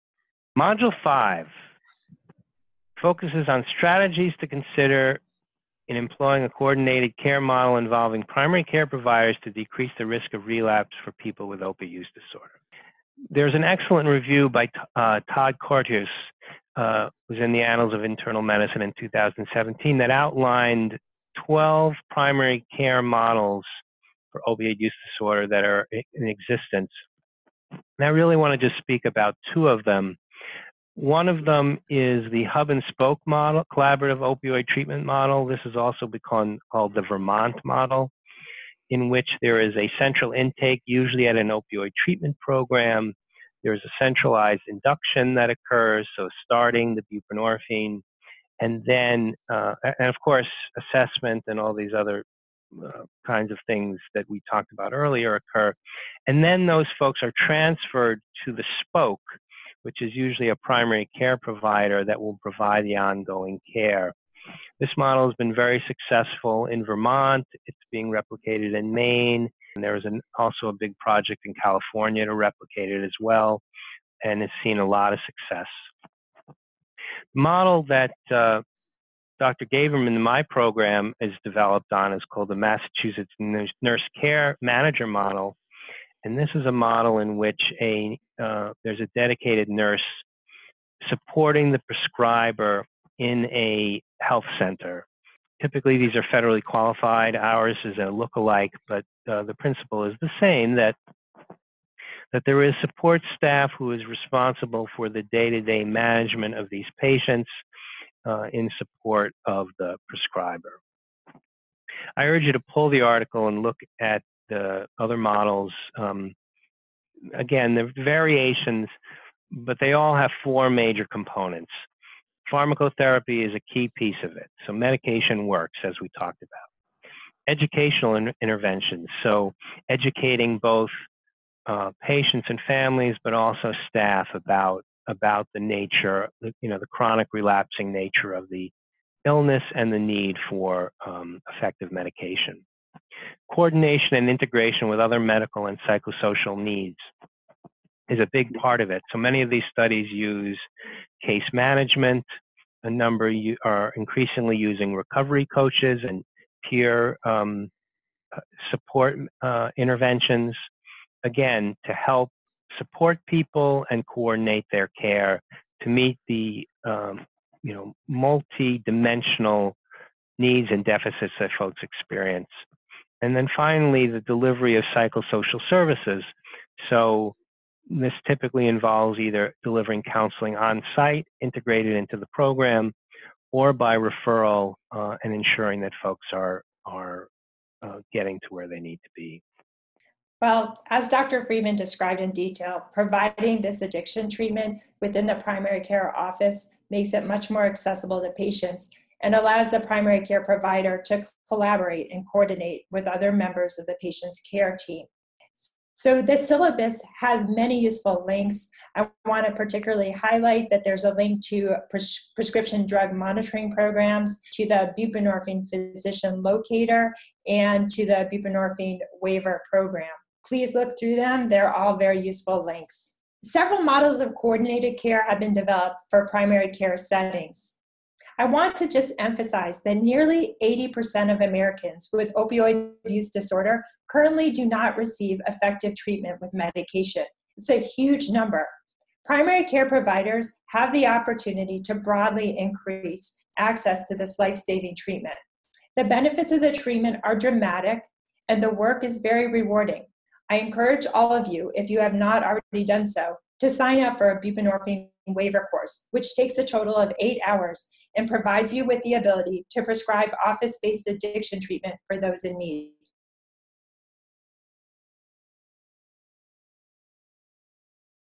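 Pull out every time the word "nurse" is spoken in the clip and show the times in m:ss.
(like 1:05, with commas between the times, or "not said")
1:23, 1:29.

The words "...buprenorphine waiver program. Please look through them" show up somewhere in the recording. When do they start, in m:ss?
3:38.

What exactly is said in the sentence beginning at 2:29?
So many of these studies use case management.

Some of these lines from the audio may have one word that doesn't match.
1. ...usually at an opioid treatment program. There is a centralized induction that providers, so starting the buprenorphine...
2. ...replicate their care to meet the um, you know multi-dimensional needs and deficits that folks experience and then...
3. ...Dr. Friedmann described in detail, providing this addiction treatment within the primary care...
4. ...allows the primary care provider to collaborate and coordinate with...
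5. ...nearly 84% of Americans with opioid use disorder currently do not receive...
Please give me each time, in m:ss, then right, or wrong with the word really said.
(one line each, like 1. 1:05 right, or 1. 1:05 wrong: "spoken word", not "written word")
1. 0:40 wrong: "occurs", not "providers"
2. 2:44 wrong: "coordinate", not "replicate"
3. 3:11 right
4. 3:19 right
5. 3:49 wrong: "80", not "84".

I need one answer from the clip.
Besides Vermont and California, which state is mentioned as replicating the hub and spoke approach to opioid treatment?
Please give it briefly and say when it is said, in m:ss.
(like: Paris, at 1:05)
Maine, at 1:08.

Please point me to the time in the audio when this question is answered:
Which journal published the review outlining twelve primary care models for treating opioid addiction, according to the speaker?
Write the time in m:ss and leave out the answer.
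0:17.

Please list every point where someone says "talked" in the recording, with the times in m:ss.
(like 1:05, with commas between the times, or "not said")
0:54, 2:06.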